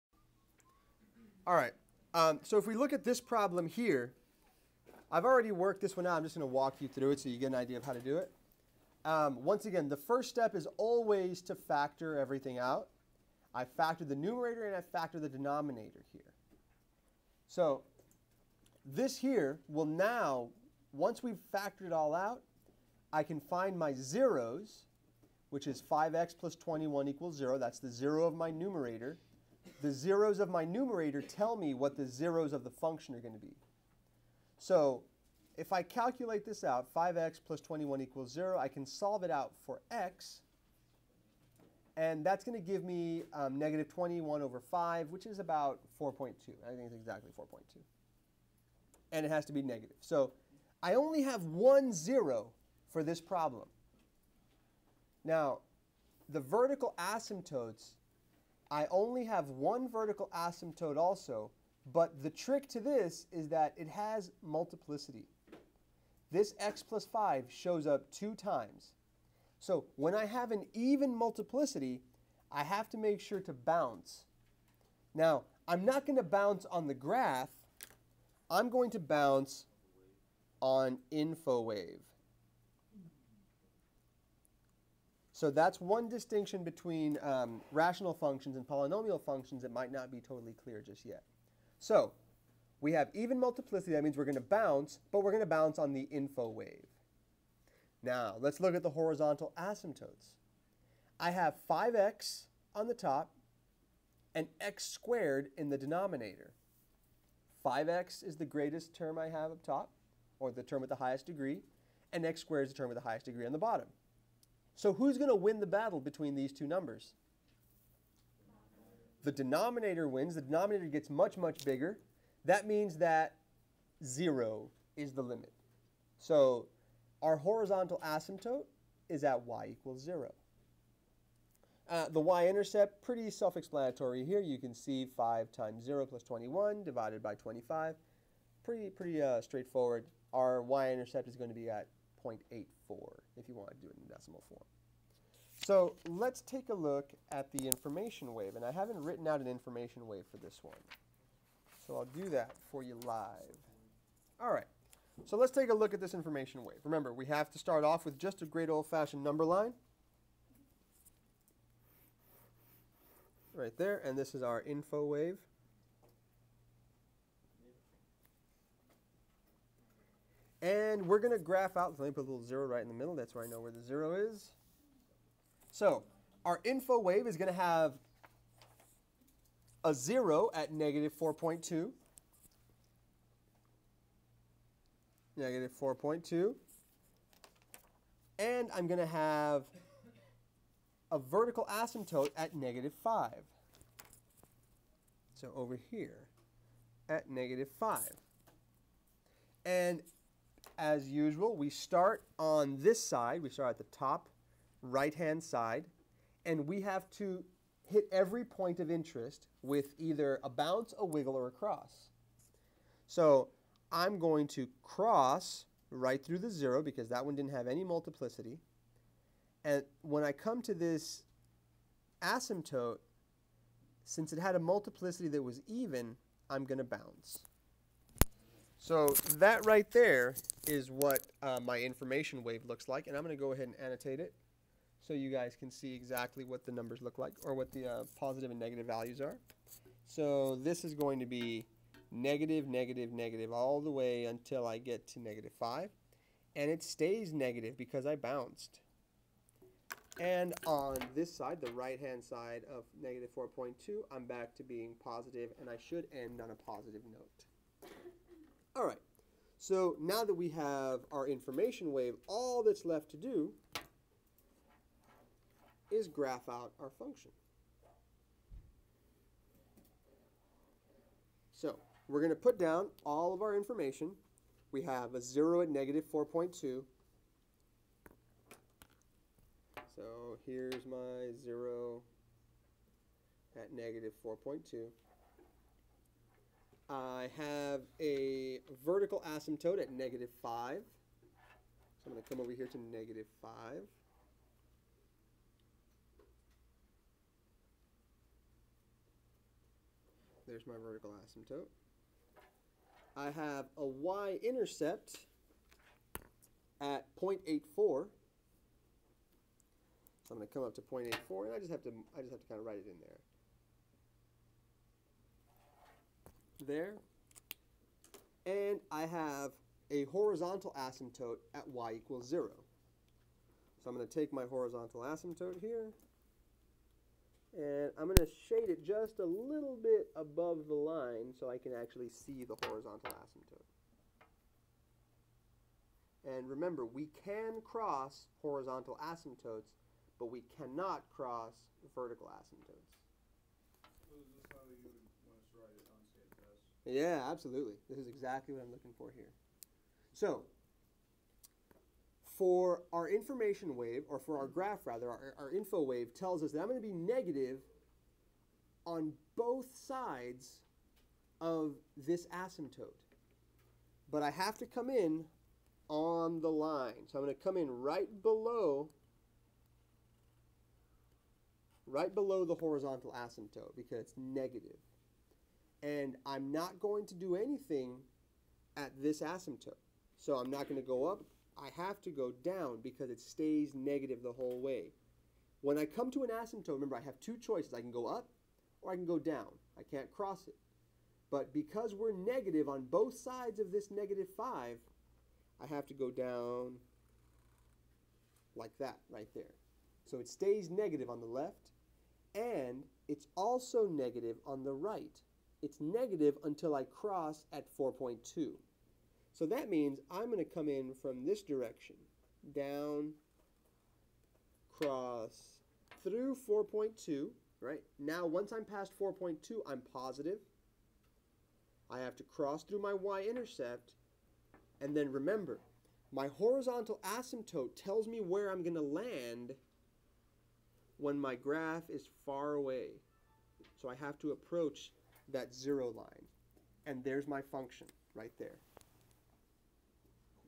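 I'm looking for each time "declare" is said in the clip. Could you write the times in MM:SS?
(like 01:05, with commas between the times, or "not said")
not said.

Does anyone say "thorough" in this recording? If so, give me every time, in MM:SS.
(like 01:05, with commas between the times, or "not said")
not said.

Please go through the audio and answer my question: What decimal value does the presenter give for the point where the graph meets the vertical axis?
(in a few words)
0.84.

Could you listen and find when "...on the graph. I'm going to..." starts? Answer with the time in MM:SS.
01:16.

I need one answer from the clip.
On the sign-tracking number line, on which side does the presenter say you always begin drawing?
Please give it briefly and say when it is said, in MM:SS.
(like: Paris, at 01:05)
top right-hand side, at 03:23.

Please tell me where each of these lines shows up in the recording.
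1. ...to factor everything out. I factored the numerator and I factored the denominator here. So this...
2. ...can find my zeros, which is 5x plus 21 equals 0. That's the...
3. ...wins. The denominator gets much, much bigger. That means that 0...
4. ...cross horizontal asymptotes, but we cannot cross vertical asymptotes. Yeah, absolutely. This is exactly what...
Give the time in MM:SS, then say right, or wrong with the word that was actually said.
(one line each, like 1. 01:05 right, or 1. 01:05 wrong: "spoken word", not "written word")
1. 00:11 right
2. 00:23 right
3. 02:00 right
4. 05:37 right.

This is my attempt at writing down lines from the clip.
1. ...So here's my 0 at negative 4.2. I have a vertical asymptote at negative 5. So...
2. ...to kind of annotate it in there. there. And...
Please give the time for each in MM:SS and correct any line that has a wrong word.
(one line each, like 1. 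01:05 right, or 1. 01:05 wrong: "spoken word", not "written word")
1. 04:39 right
2. 05:12 wrong: "write", not "annotate".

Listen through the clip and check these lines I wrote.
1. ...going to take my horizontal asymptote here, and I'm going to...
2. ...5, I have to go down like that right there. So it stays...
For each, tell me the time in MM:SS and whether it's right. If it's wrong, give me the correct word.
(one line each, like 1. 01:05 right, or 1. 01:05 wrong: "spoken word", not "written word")
1. 05:23 right
2. 06:34 right.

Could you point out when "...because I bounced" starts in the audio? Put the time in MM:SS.
04:07.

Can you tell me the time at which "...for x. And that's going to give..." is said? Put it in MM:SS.
00:39.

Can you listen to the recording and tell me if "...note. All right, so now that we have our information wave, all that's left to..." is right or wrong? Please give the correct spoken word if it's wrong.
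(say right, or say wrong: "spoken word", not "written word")
right.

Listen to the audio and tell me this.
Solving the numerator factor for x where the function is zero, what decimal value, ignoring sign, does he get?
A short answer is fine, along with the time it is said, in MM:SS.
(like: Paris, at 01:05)
4.2, at 00:46.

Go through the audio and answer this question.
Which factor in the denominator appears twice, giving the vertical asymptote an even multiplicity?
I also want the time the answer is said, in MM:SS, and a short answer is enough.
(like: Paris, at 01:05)
x + 5, at 01:06.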